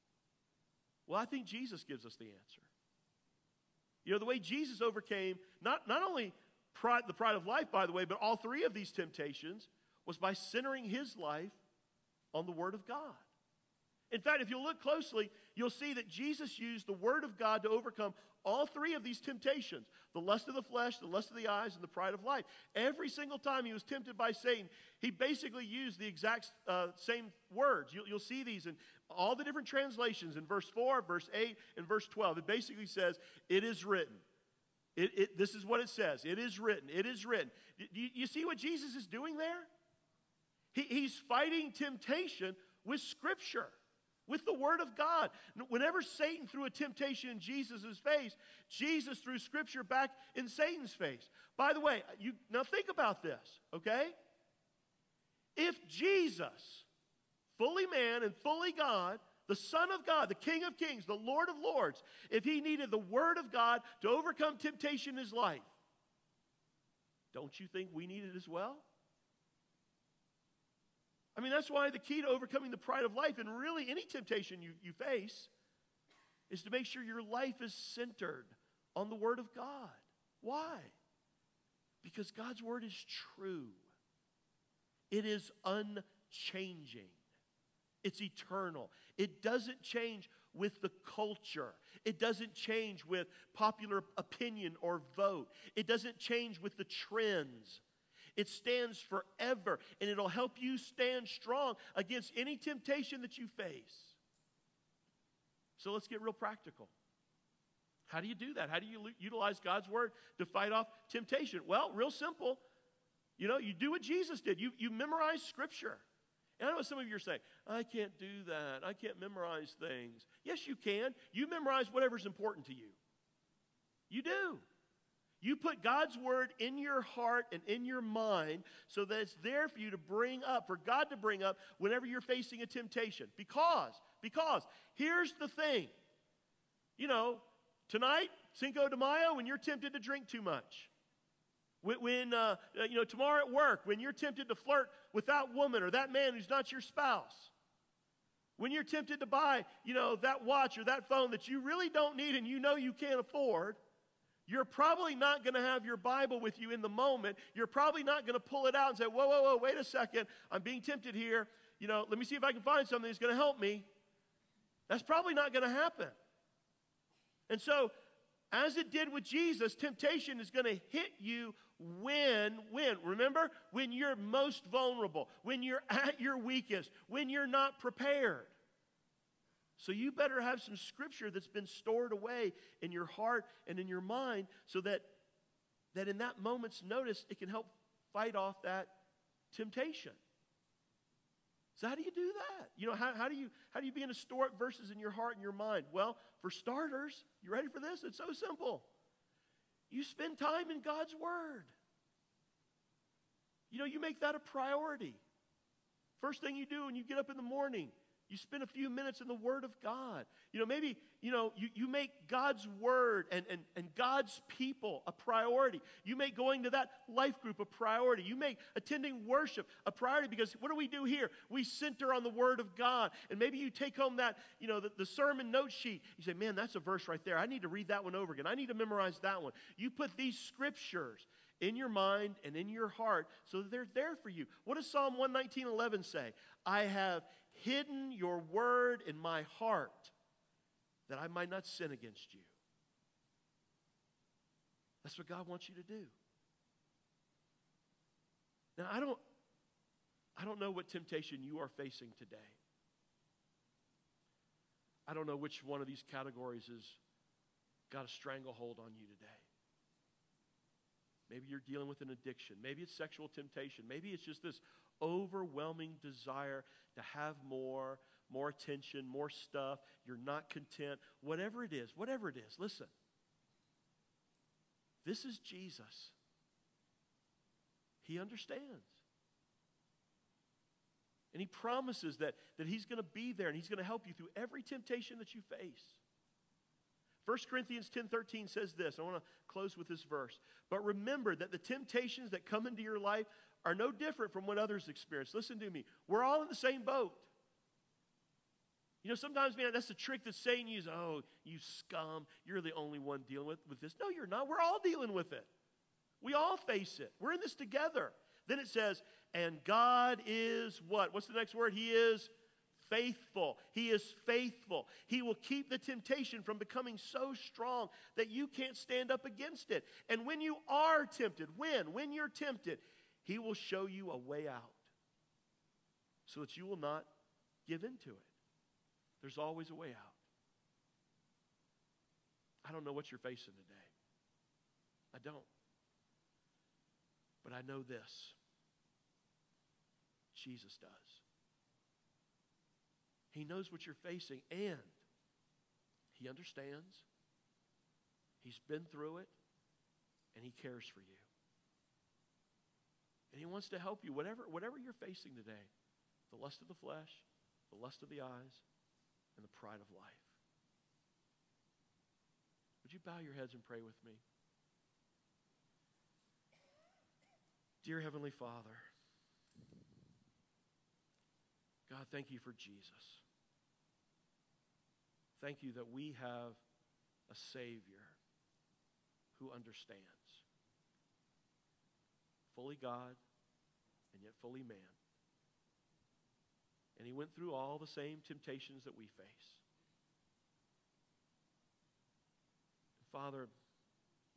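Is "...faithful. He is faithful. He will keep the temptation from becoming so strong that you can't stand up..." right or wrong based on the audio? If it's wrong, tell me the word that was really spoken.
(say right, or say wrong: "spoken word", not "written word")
right.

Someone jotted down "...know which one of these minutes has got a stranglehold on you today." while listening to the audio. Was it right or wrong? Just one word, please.
wrong.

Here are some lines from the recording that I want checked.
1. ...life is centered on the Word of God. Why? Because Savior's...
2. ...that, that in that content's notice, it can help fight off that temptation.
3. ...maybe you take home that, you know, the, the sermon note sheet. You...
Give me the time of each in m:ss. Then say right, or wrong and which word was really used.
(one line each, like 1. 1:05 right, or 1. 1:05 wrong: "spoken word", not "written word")
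1. 1:17 wrong: "God", not "Savior"
2. 3:04 wrong: "moment", not "content"
3. 3:43 right.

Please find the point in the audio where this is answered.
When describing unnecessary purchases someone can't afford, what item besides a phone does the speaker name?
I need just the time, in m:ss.
2:30.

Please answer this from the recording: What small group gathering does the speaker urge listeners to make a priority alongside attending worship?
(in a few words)
life group.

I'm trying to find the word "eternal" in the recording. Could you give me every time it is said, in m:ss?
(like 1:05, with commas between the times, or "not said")
1:28.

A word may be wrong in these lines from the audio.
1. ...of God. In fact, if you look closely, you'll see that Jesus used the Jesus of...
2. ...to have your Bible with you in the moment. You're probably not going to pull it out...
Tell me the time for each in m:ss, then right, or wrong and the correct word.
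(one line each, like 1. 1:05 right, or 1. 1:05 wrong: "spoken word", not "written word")
1. 0:12 wrong: "Word", not "Jesus"
2. 2:35 right.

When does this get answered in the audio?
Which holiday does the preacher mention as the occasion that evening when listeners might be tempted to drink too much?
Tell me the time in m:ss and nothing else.
2:18.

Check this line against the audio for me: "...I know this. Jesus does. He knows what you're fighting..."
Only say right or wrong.
wrong.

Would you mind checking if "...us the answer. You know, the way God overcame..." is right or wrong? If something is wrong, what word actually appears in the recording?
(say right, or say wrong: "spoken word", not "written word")
wrong: "Jesus", not "God".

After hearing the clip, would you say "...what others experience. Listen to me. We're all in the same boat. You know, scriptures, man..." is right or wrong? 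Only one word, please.
wrong.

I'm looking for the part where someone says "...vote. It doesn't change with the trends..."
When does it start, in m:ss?
1:35.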